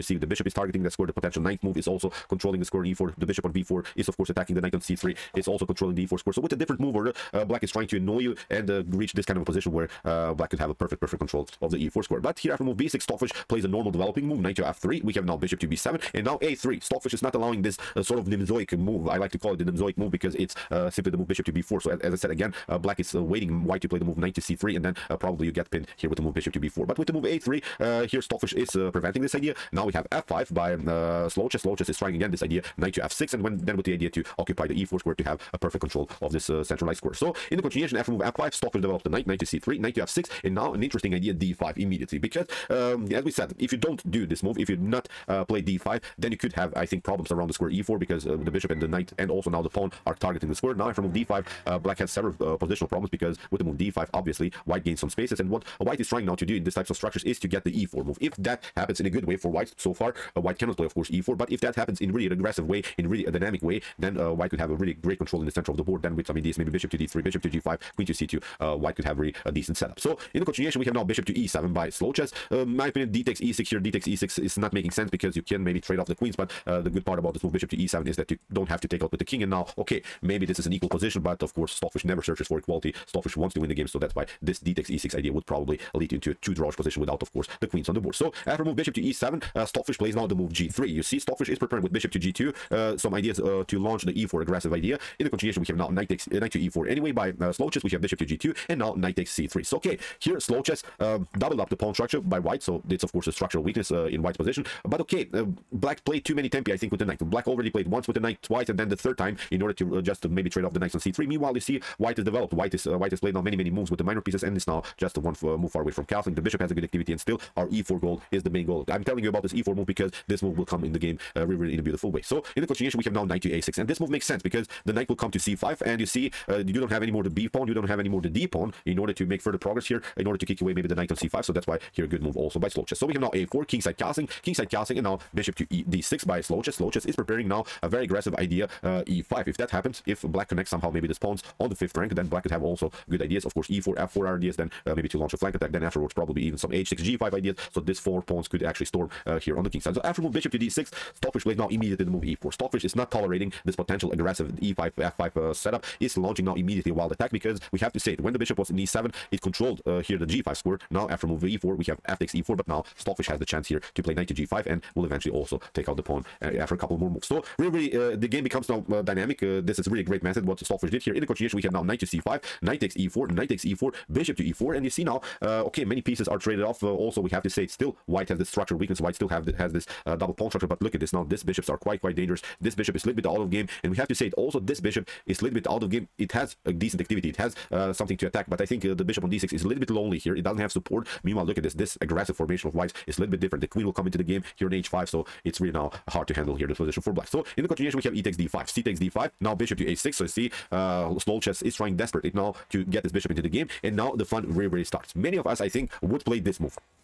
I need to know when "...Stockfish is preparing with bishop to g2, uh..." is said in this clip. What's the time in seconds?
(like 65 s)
91 s.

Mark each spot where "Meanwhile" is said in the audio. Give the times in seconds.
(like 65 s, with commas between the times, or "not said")
111 s, 191 s.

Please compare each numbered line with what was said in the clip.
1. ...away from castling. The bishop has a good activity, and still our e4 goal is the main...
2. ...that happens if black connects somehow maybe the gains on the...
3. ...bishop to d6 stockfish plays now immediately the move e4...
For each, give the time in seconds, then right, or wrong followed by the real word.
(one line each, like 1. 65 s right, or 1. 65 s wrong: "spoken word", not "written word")
1. 115 s right
2. 139 s wrong: "pawns", not "gains"
3. 150 s right.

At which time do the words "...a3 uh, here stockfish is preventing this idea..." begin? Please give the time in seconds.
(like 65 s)
27 s.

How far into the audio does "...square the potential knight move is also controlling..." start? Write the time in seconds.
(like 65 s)
0 s.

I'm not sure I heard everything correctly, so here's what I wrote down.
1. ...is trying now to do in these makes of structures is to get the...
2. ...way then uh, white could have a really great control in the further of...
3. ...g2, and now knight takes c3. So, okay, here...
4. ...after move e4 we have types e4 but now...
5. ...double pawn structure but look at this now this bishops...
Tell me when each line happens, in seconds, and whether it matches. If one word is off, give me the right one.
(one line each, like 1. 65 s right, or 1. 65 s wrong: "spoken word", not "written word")
1. 55 s wrong: "types", not "makes"
2. 63 s wrong: "center", not "further"
3. 98 s right
4. 161 s wrong: "takes", not "types"
5. 180 s right.